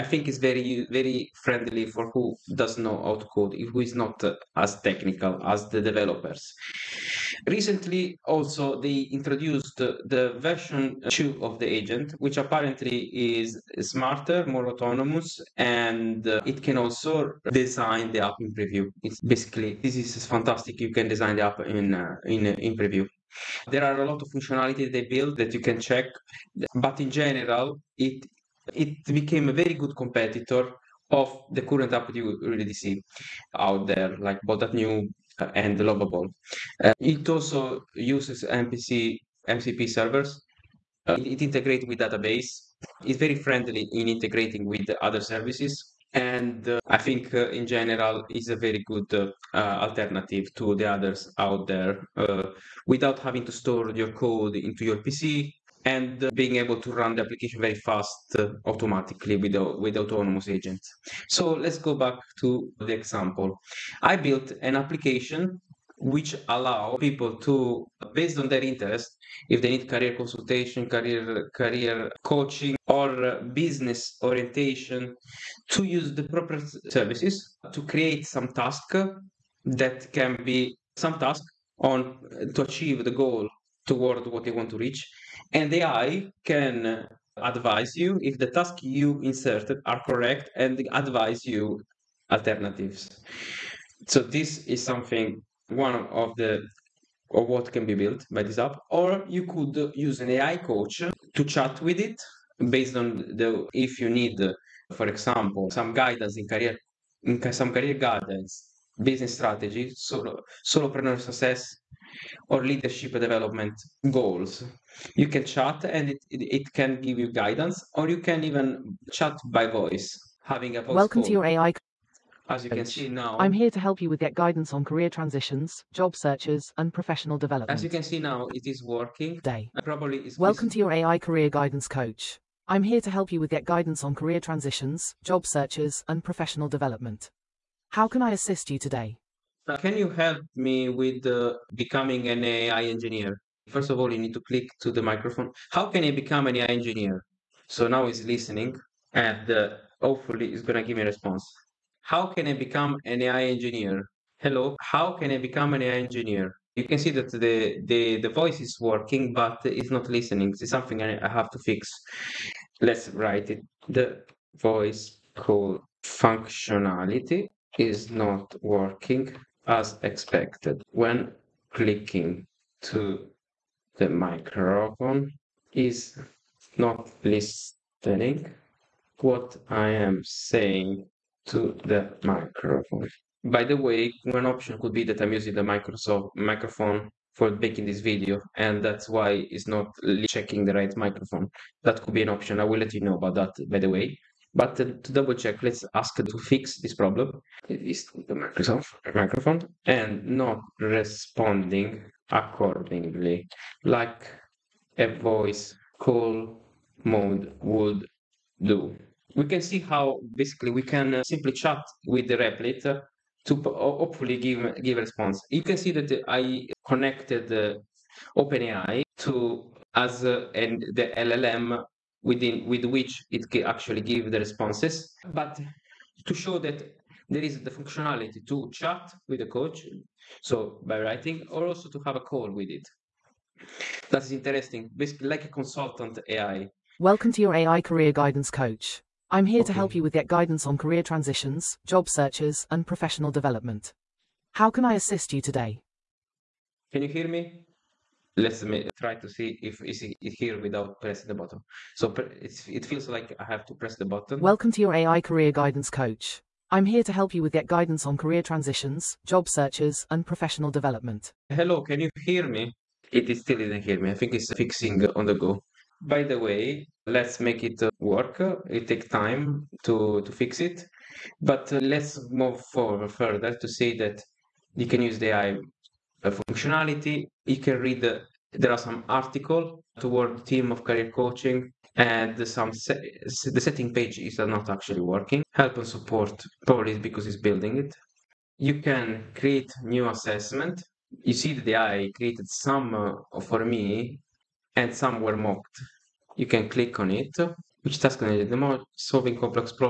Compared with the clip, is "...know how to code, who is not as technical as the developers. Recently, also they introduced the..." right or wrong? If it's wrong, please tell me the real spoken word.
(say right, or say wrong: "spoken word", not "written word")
right.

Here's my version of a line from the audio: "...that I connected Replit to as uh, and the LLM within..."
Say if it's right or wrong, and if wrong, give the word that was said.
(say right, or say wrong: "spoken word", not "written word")
wrong: "OpenAI", not "Replit".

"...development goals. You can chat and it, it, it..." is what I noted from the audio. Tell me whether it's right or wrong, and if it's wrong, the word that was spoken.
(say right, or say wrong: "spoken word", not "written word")
right.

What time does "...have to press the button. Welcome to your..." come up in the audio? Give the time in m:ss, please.
4:13.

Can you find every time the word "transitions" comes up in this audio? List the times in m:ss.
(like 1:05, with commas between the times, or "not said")
2:05, 2:14, 4:01, 4:18.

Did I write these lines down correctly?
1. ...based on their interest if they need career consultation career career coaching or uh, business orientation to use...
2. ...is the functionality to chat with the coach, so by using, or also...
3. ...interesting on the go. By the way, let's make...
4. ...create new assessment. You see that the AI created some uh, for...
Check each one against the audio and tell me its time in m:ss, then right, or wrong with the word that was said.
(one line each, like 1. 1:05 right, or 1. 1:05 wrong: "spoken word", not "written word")
1. 1:08 right
2. 3:47 wrong: "writing", not "using"
3. 4:24 wrong: "fixing", not "interesting"
4. 4:49 right.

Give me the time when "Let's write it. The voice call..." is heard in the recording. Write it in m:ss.
2:42.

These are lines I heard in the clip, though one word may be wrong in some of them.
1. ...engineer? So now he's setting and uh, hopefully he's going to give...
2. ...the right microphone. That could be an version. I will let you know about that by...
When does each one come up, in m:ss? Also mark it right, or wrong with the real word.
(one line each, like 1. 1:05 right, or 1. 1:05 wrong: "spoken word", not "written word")
1. 2:26 wrong: "listening", not "setting"
2. 3:10 wrong: "option", not "version".